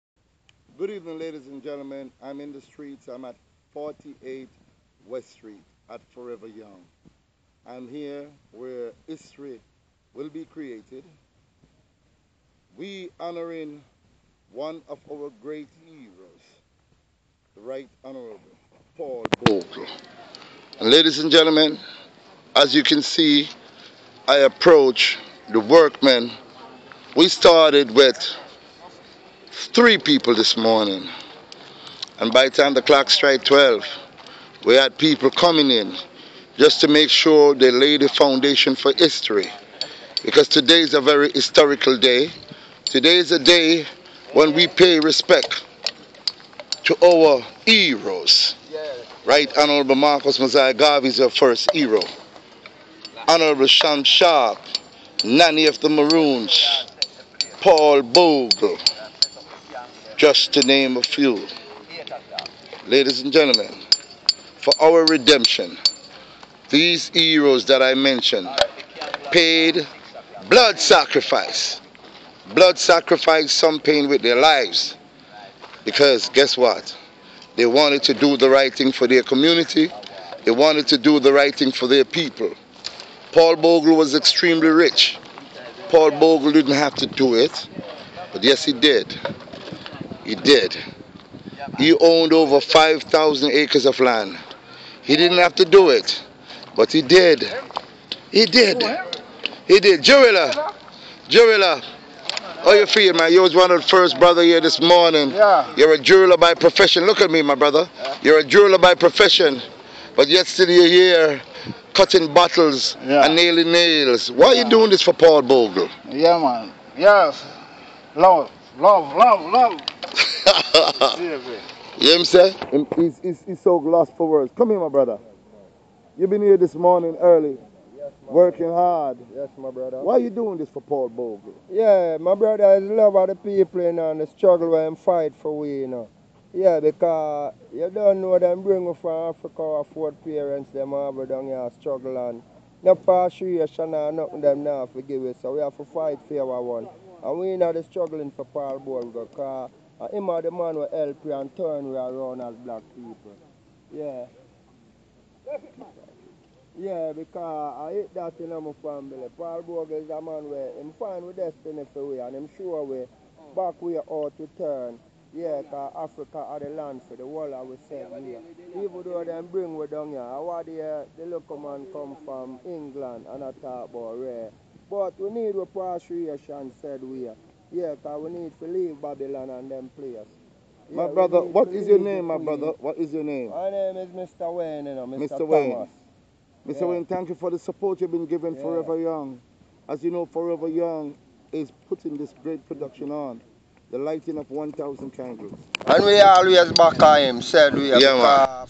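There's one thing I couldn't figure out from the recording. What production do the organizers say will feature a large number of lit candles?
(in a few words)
The lighting of 1,000 candles.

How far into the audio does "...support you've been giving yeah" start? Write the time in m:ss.
3:07.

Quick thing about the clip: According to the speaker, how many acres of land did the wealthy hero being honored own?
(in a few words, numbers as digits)
5,000.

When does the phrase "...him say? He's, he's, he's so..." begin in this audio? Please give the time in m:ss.
2:02.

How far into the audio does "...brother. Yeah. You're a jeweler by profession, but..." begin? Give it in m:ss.
1:47.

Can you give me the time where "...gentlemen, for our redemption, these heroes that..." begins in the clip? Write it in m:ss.
1:03.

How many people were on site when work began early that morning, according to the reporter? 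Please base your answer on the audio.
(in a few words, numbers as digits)
3.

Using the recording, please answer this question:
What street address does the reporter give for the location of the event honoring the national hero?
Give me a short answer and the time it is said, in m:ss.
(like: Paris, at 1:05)
48 West Street, at 0:03.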